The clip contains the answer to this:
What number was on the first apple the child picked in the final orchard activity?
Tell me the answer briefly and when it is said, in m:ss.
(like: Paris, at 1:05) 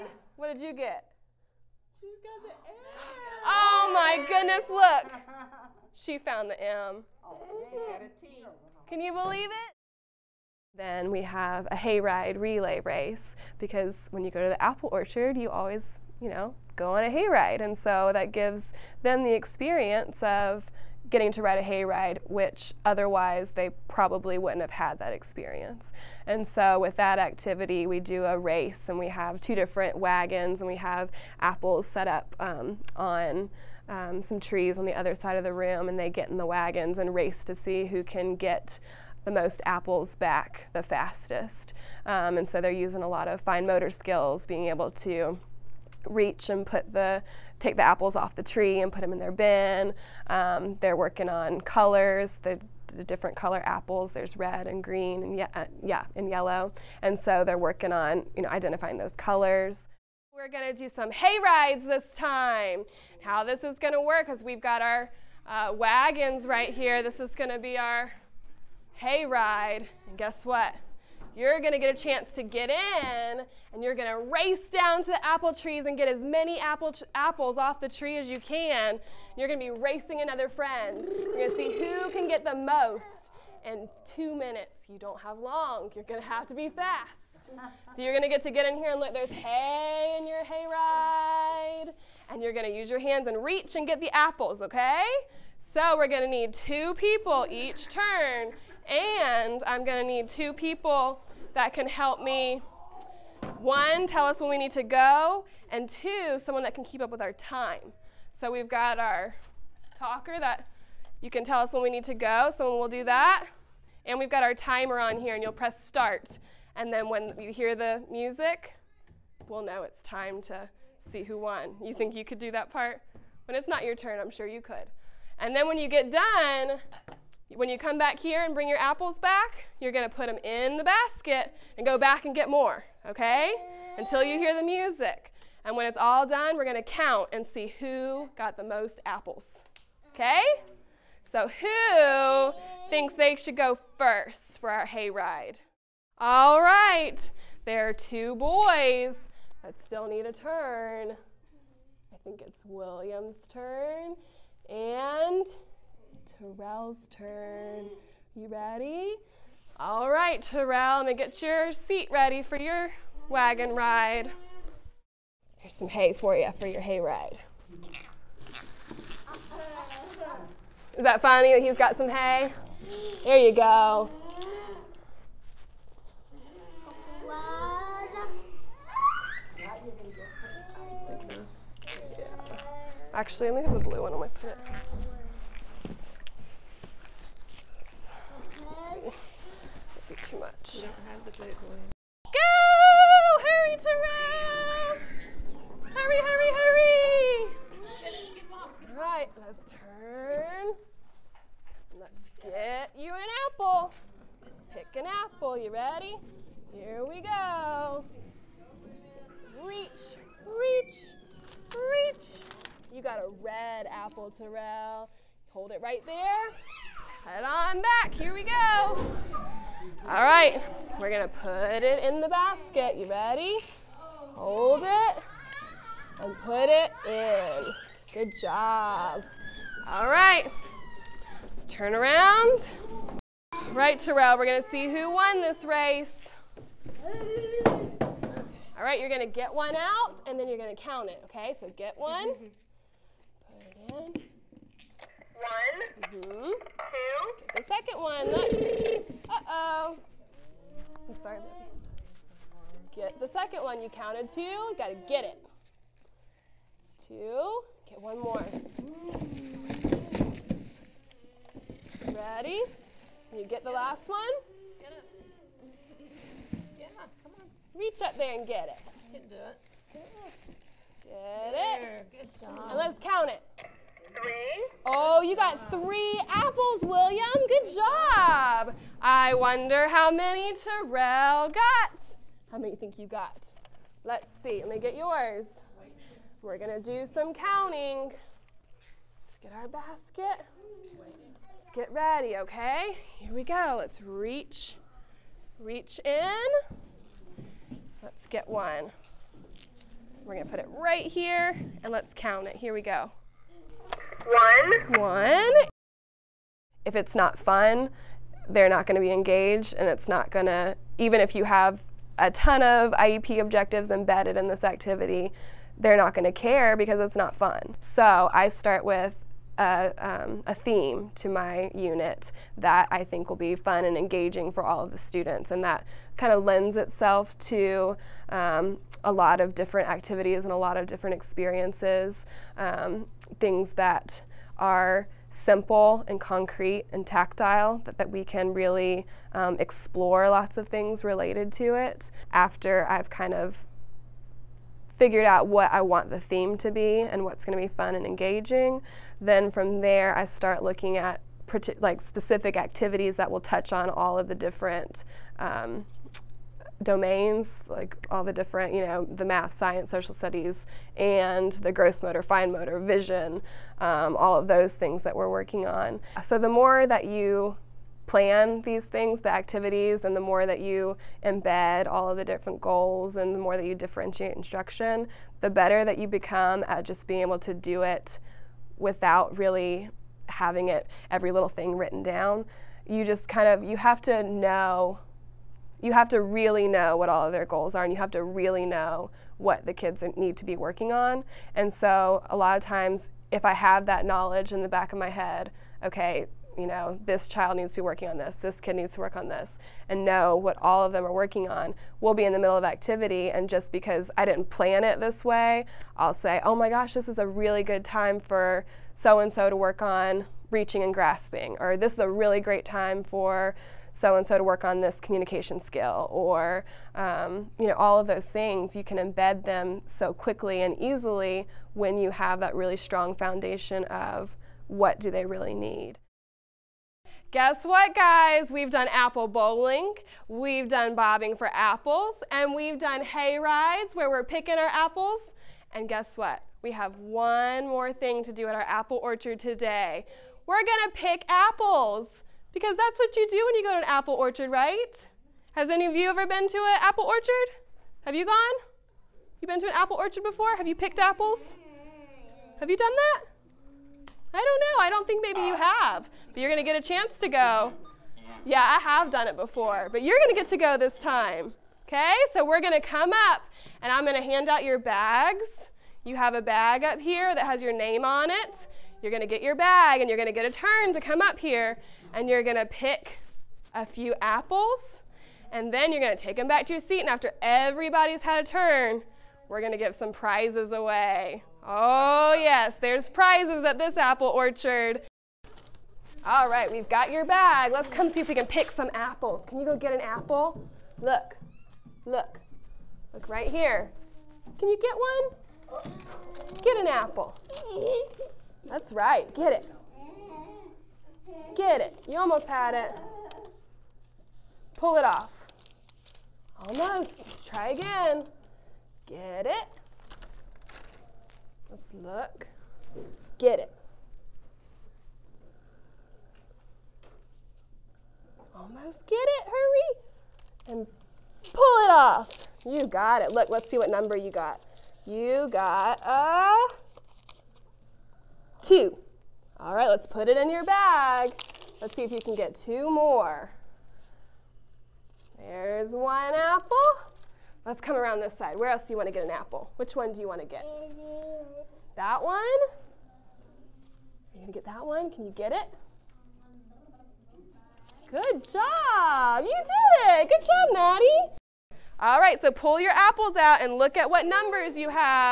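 2, at 8:45.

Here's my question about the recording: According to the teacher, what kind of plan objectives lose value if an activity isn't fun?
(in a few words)
IEP objectives.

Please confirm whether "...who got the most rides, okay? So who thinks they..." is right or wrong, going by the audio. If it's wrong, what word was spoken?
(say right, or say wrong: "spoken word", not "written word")
wrong: "apples", not "rides".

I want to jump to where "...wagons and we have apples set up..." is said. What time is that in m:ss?
0:29.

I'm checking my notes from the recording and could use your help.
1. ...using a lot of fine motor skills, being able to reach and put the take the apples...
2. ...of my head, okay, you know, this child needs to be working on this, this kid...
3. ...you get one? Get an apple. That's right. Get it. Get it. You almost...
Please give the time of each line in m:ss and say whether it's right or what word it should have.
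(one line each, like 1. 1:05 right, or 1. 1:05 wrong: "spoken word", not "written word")
1. 0:42 right
2. 6:34 right
3. 8:14 right.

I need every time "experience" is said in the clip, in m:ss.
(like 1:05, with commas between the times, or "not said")
0:19, 0:25, 5:31.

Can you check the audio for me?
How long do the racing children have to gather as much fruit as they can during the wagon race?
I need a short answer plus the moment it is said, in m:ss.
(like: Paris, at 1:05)
2 minutes, at 1:24.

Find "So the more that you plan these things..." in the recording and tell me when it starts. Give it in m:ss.
6:06.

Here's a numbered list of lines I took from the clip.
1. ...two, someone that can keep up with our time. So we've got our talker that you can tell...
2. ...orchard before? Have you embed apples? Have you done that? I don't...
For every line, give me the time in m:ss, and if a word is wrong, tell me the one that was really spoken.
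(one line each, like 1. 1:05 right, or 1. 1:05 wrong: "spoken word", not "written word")
1. 1:45 right
2. 7:29 wrong: "picked", not "embed".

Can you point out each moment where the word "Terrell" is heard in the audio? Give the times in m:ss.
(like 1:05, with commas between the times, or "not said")
2:36, 2:40, 3:13, 3:34, 3:53, 4:40.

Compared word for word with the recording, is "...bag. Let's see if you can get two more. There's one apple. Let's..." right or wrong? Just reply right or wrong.
right.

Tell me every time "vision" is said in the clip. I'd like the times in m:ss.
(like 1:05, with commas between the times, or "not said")
6:02.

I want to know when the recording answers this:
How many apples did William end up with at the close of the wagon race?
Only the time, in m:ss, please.
4:35.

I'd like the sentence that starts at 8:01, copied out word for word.
Oh yes, there's prizes at this apple orchard.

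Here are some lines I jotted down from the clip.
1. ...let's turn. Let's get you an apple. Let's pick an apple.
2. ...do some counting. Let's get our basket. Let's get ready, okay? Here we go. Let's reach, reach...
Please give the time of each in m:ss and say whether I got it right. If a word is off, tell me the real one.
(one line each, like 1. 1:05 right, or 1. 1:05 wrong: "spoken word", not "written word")
1. 3:19 right
2. 4:46 right.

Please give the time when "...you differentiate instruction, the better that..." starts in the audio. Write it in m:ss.
6:13.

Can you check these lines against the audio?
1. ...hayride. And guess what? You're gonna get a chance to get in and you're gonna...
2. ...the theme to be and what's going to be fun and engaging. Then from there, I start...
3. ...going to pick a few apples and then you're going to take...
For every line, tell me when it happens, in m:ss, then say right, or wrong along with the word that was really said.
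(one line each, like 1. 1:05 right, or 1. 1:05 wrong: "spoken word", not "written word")
1. 1:08 right
2. 5:46 right
3. 7:52 right.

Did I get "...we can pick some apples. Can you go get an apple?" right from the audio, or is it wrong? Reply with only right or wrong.
right.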